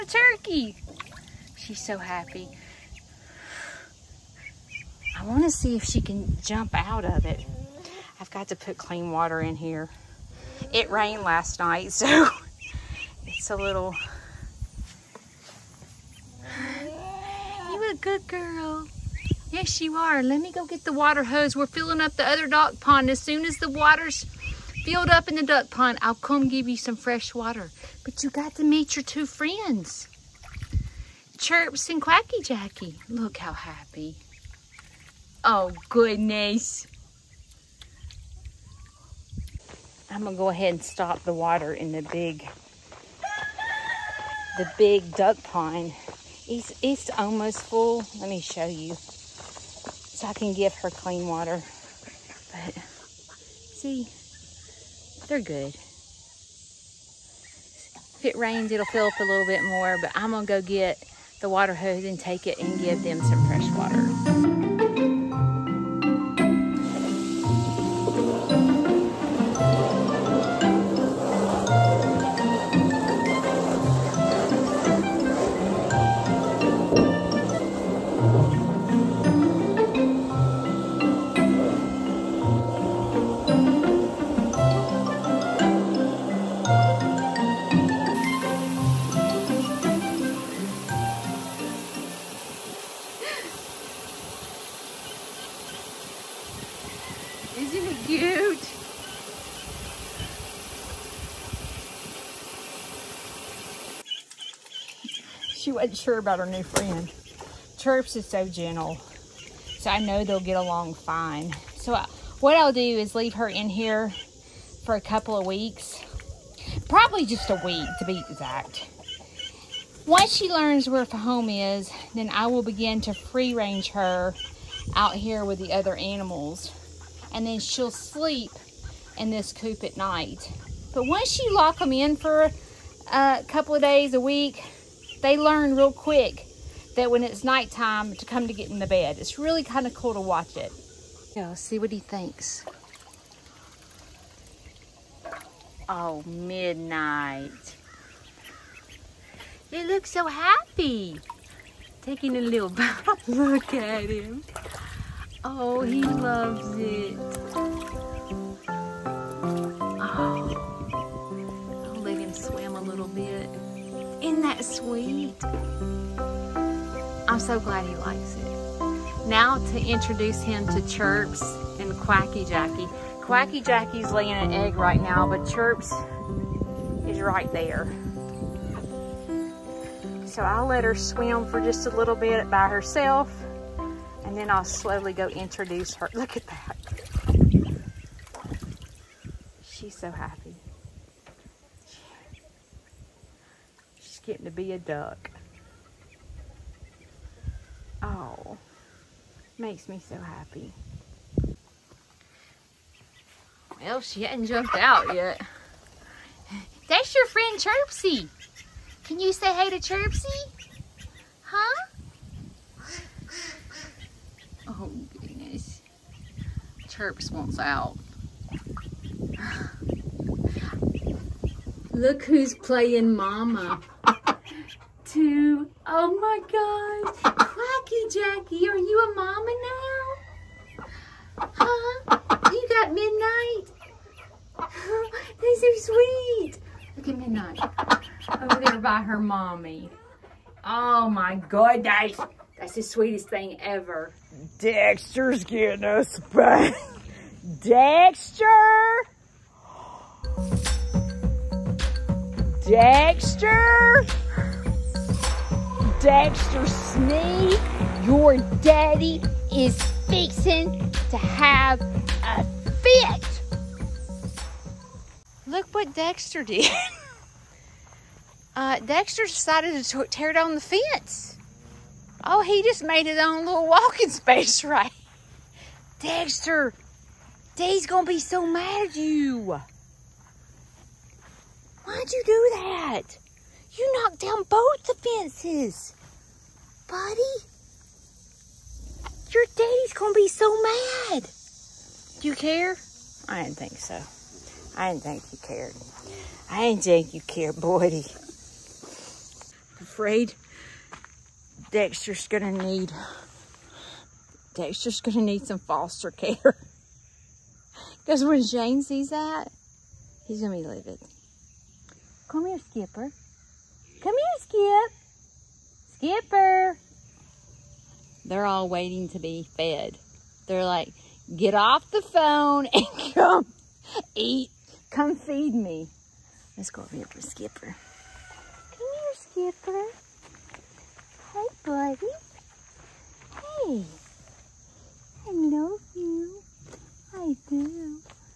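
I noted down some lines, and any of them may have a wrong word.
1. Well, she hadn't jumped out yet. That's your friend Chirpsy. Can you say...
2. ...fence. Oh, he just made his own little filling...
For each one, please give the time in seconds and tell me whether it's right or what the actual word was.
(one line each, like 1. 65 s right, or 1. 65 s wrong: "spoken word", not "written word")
1. 203 s right
2. 270 s wrong: "walking", not "filling".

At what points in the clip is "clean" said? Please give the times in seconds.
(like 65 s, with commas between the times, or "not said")
8 s, 50 s.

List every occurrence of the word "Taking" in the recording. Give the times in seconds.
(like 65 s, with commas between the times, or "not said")
152 s.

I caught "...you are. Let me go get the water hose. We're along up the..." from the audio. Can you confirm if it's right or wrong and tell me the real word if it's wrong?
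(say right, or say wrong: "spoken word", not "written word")
wrong: "filling", not "along".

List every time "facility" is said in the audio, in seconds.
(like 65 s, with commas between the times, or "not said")
not said.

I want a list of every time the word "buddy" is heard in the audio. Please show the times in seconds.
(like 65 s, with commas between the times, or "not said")
286 s, 297 s, 331 s.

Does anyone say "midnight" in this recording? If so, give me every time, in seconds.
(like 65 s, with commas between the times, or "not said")
146 s, 232 s, 237 s.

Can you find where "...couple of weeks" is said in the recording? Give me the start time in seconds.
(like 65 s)
115 s.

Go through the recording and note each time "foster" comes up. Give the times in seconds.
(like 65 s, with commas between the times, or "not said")
305 s.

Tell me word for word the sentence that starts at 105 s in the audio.
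She wasn't sure about her new friend.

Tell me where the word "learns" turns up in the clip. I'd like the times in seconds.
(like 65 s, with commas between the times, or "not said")
120 s, 135 s.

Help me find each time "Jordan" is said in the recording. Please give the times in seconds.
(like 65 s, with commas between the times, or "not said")
not said.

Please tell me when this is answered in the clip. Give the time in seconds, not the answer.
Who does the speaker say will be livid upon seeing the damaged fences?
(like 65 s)
308 s.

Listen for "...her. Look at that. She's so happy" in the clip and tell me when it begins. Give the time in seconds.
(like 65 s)
185 s.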